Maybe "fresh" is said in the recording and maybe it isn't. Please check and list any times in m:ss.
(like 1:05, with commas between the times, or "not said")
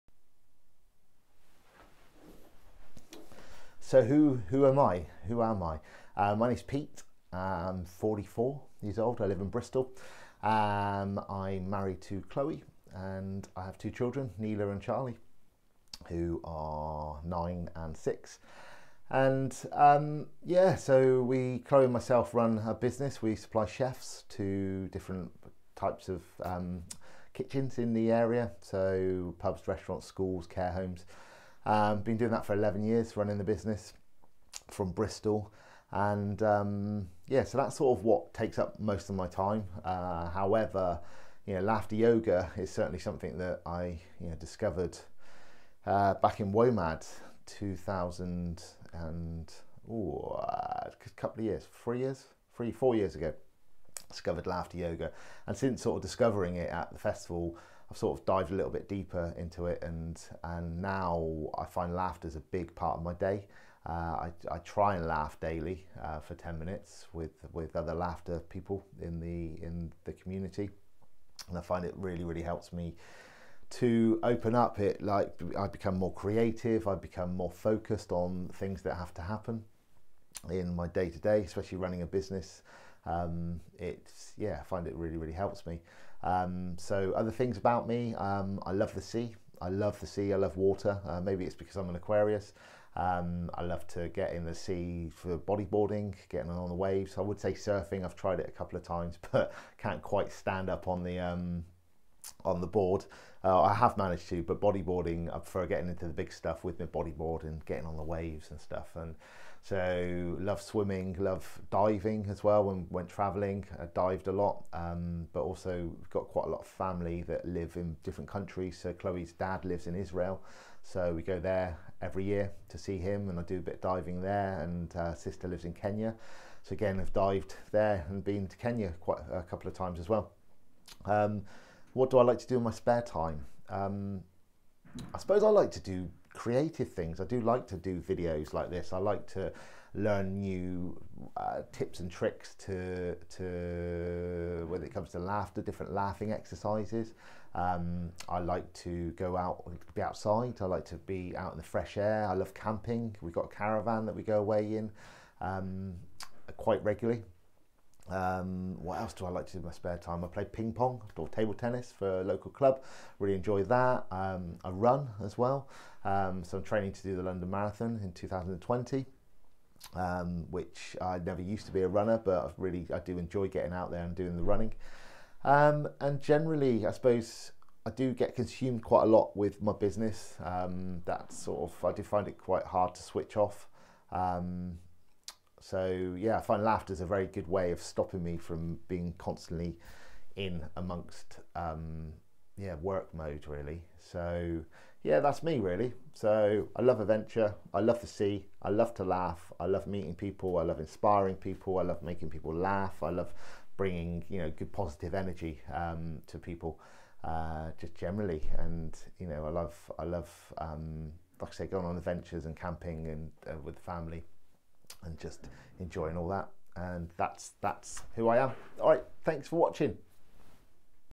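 2:31.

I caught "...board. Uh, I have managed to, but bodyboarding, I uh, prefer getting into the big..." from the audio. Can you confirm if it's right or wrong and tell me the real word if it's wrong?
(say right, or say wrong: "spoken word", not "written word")
right.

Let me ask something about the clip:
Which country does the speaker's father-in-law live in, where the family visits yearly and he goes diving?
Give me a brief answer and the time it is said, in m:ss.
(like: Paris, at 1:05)
Israel, at 1:59.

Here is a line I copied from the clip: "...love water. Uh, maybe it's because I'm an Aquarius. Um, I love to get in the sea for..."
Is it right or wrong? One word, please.
right.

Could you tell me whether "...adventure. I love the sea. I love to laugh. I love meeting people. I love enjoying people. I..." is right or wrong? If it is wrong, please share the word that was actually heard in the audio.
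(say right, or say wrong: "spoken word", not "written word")
wrong: "inspiring", not "enjoying".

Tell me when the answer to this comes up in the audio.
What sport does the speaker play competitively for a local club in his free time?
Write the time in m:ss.
2:41.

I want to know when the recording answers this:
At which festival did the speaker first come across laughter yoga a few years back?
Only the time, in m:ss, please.
0:46.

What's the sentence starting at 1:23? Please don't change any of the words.
Um, it's yeah, I find it really really helps me.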